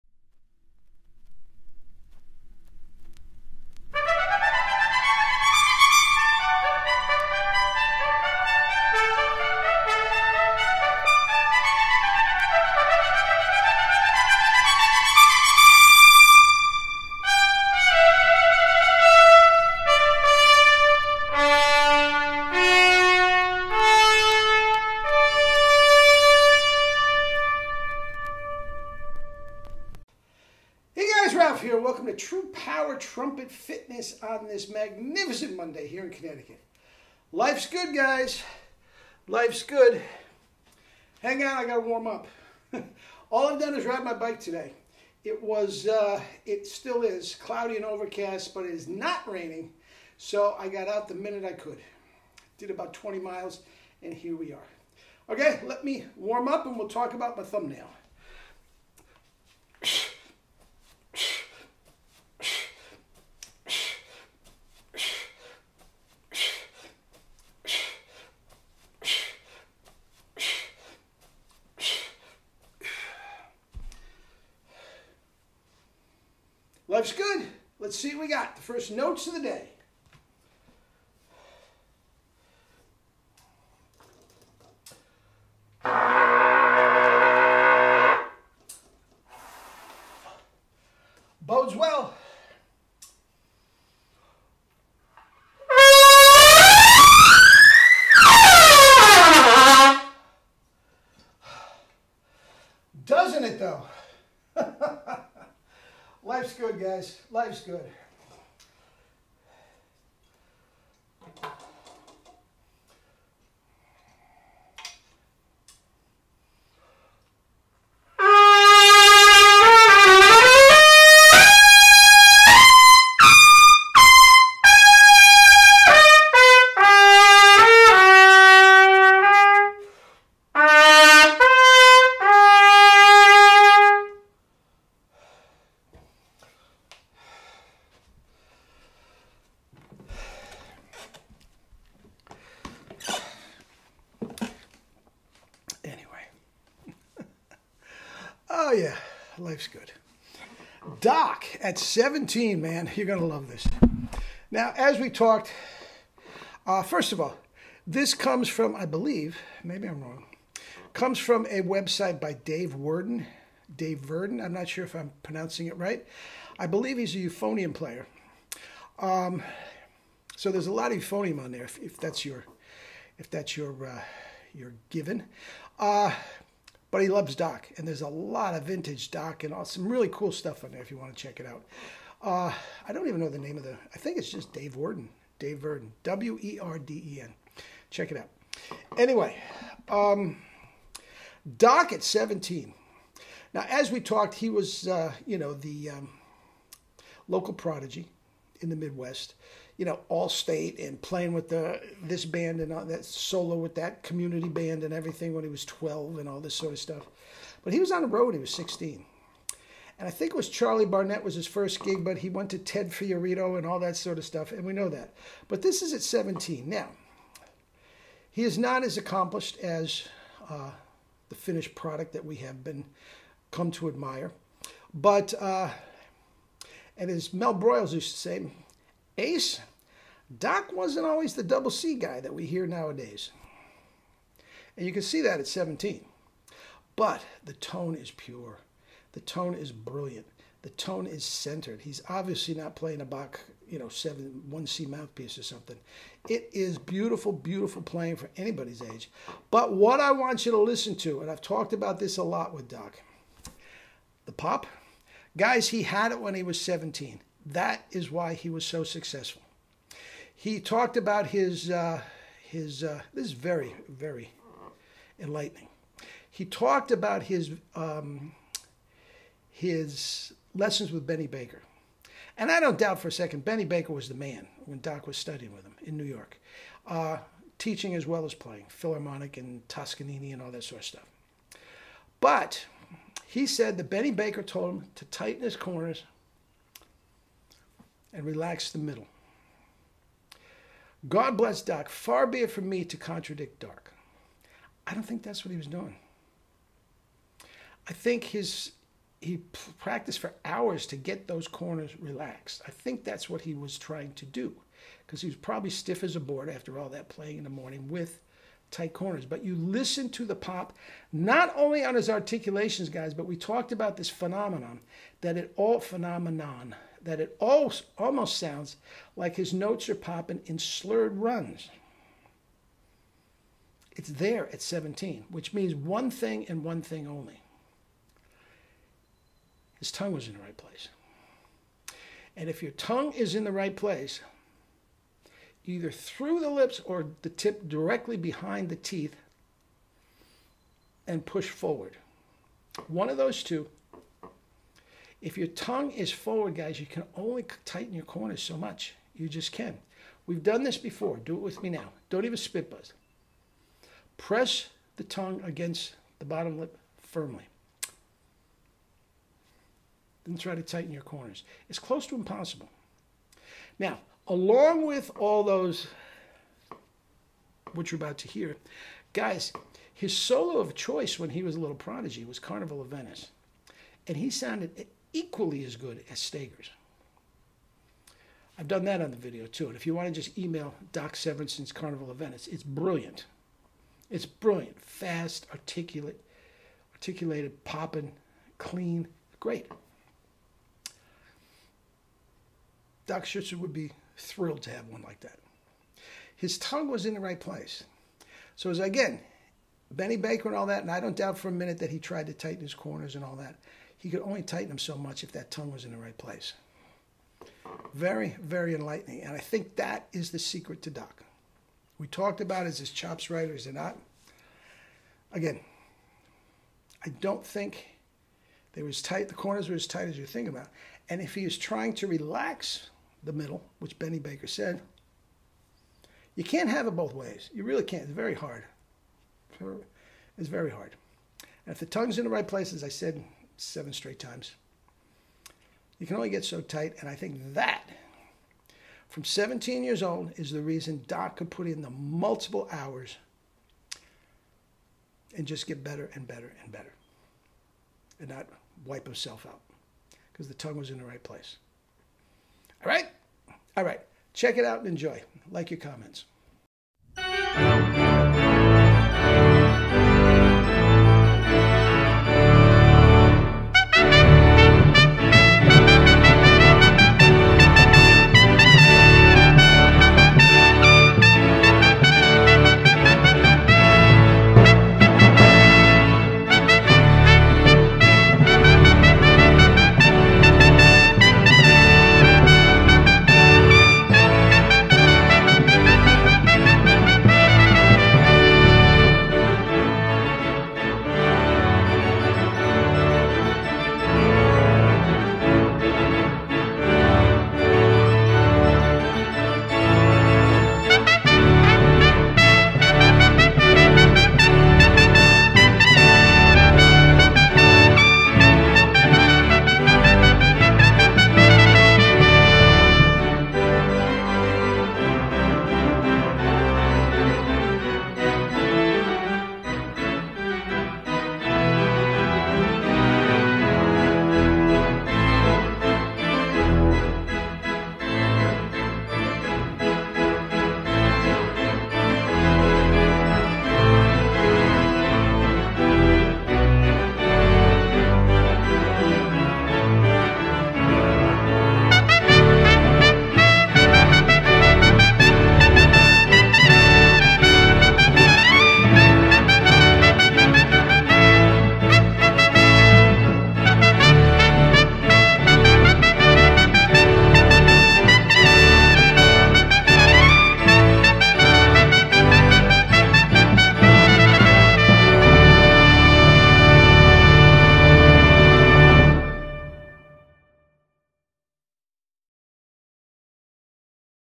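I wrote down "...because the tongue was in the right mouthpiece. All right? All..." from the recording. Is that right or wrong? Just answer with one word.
wrong.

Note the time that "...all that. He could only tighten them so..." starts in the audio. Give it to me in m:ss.
6:43.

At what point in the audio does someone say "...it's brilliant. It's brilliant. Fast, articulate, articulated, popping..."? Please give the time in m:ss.
6:22.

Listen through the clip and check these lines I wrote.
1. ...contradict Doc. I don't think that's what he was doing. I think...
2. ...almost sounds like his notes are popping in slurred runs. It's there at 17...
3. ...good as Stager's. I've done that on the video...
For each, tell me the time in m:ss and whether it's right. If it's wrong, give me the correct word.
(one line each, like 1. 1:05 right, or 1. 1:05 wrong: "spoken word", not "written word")
1. 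4:52 right
2. 5:17 right
3. 6:15 right.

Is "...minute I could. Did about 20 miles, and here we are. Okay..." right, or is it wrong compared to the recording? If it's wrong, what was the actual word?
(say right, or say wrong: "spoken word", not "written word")
right.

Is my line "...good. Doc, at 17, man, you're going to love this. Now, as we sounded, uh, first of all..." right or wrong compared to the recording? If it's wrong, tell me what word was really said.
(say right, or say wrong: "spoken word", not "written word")
wrong: "talked", not "sounded".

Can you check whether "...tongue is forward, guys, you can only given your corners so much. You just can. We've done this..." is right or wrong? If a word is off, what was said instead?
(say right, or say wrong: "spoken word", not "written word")
wrong: "tighten", not "given".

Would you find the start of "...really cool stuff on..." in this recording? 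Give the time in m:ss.
2:59.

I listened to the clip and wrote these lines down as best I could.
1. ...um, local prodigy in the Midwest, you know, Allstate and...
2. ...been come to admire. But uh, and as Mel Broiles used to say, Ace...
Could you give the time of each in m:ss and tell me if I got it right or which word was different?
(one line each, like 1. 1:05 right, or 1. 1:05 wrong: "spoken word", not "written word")
1. 3:15 right
2. 3:42 right.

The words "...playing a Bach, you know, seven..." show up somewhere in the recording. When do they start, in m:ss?
4:02.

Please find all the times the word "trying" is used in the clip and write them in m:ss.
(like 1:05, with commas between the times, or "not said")
5:03, 7:01.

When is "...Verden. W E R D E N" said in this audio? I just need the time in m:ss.
3:05.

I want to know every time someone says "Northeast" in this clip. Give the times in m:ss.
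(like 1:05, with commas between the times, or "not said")
not said.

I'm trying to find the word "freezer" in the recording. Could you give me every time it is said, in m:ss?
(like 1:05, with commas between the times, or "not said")
not said.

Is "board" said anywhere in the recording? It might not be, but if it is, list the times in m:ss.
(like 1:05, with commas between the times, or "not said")
5:06.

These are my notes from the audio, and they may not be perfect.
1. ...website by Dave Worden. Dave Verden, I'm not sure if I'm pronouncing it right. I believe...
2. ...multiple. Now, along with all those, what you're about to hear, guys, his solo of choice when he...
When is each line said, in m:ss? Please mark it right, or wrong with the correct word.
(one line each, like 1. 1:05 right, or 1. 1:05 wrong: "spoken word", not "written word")
1. 2:41 right
2. 6:02 wrong: "impossible", not "multiple".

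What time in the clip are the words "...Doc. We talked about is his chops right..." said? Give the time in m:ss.
6:50.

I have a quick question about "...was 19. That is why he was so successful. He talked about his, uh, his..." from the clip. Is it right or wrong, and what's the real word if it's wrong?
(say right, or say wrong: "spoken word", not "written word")
wrong: "17", not "19".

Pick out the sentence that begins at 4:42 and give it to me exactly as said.
But he said that Benny Baker told him to tighten his corners and relax the middle.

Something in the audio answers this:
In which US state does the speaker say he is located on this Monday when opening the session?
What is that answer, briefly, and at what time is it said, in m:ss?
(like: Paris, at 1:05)
Connecticut, at 0:36.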